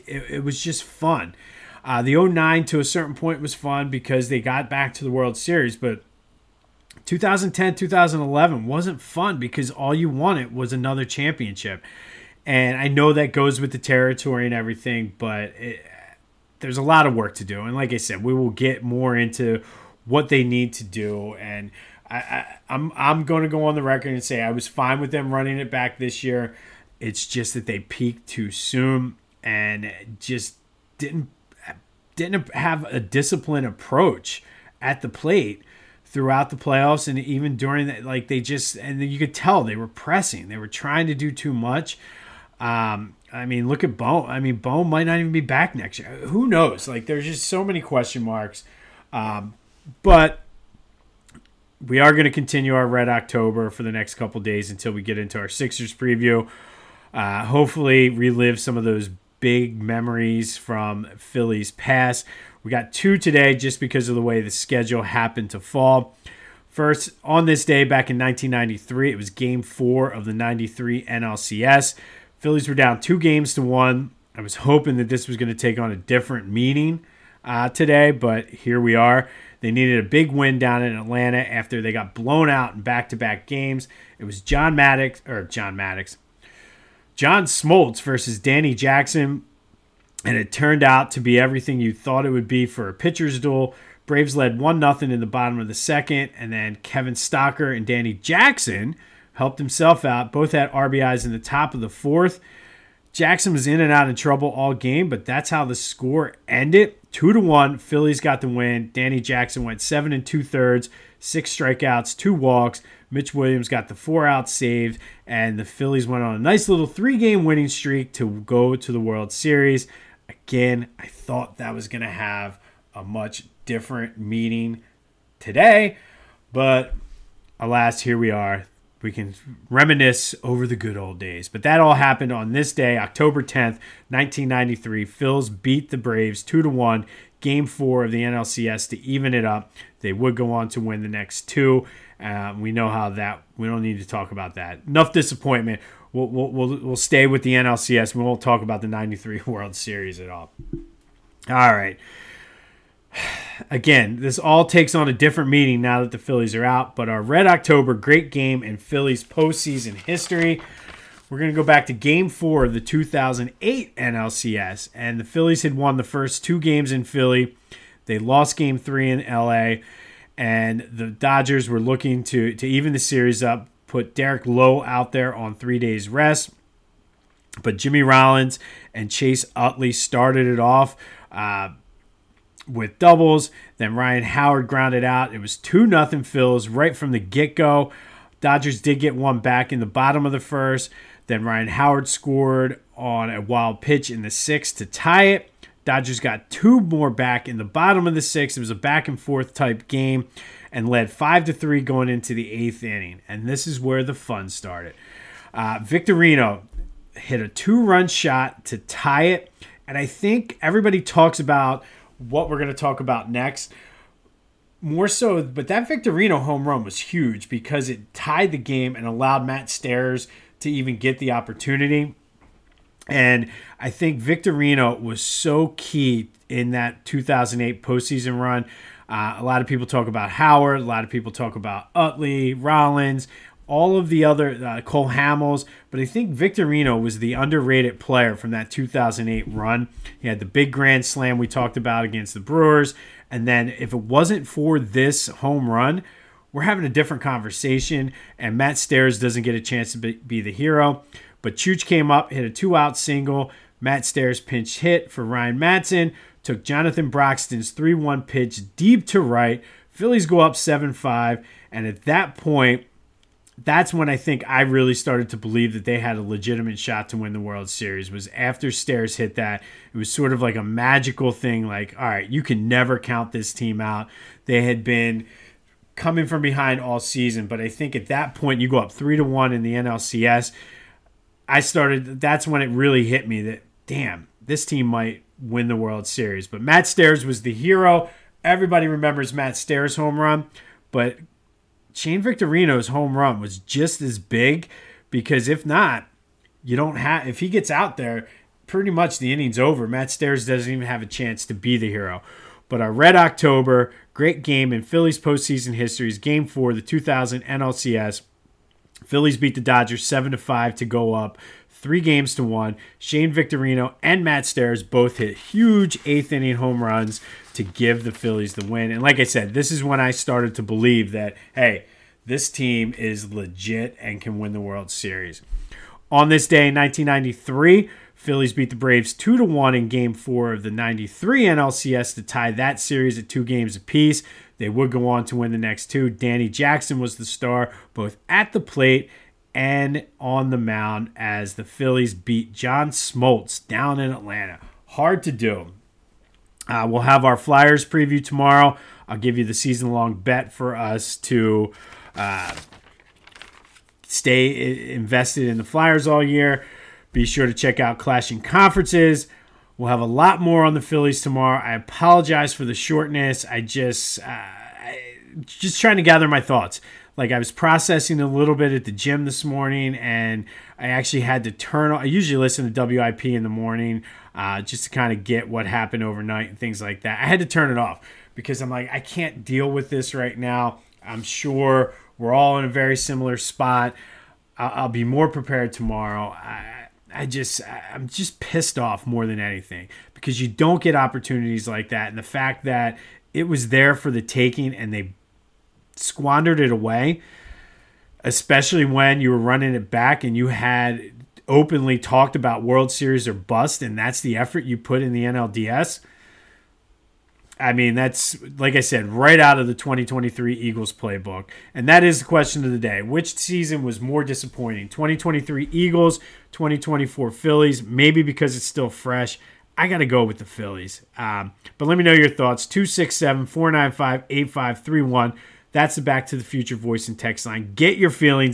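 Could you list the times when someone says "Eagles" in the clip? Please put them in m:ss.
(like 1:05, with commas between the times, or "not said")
6:50, 6:55.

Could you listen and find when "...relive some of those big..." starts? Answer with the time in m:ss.
0:58.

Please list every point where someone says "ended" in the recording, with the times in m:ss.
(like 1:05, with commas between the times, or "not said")
1:46.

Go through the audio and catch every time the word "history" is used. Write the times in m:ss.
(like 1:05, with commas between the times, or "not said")
2:39, 5:05.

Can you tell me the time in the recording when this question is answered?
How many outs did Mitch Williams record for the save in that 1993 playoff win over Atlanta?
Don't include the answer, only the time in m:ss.
1:53.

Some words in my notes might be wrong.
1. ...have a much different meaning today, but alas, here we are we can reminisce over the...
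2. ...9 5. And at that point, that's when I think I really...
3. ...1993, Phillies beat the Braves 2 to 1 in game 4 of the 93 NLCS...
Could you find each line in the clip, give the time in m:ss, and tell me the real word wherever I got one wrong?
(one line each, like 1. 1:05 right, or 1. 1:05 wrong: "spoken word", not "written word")
1. 2:02 right
2. 4:20 wrong: "7", not "9"
3. 5:26 right.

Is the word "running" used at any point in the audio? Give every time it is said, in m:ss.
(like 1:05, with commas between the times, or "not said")
0:25, 6:39.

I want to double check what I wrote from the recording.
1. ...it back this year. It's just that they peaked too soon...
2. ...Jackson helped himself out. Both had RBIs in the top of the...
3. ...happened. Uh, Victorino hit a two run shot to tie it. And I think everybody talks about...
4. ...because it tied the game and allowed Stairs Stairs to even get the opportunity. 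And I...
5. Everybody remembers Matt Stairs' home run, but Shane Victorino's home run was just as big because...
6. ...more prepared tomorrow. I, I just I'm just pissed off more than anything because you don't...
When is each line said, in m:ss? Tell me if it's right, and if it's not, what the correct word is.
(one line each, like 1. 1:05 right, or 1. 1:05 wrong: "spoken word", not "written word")
1. 0:25 right
2. 1:38 right
3. 3:24 wrong: "started", not "happened"
4. 3:37 wrong: "Matt", not "Stairs"
5. 4:48 right
6. 6:25 right.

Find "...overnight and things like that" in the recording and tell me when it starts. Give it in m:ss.
6:16.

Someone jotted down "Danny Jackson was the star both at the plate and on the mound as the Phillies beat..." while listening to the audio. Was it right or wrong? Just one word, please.
right.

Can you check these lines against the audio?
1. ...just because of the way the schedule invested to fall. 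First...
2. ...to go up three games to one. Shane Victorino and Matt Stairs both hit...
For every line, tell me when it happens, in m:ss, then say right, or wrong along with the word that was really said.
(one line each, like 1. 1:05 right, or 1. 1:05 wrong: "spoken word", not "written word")
1. 1:03 wrong: "happened", not "invested"
2. 5:10 right.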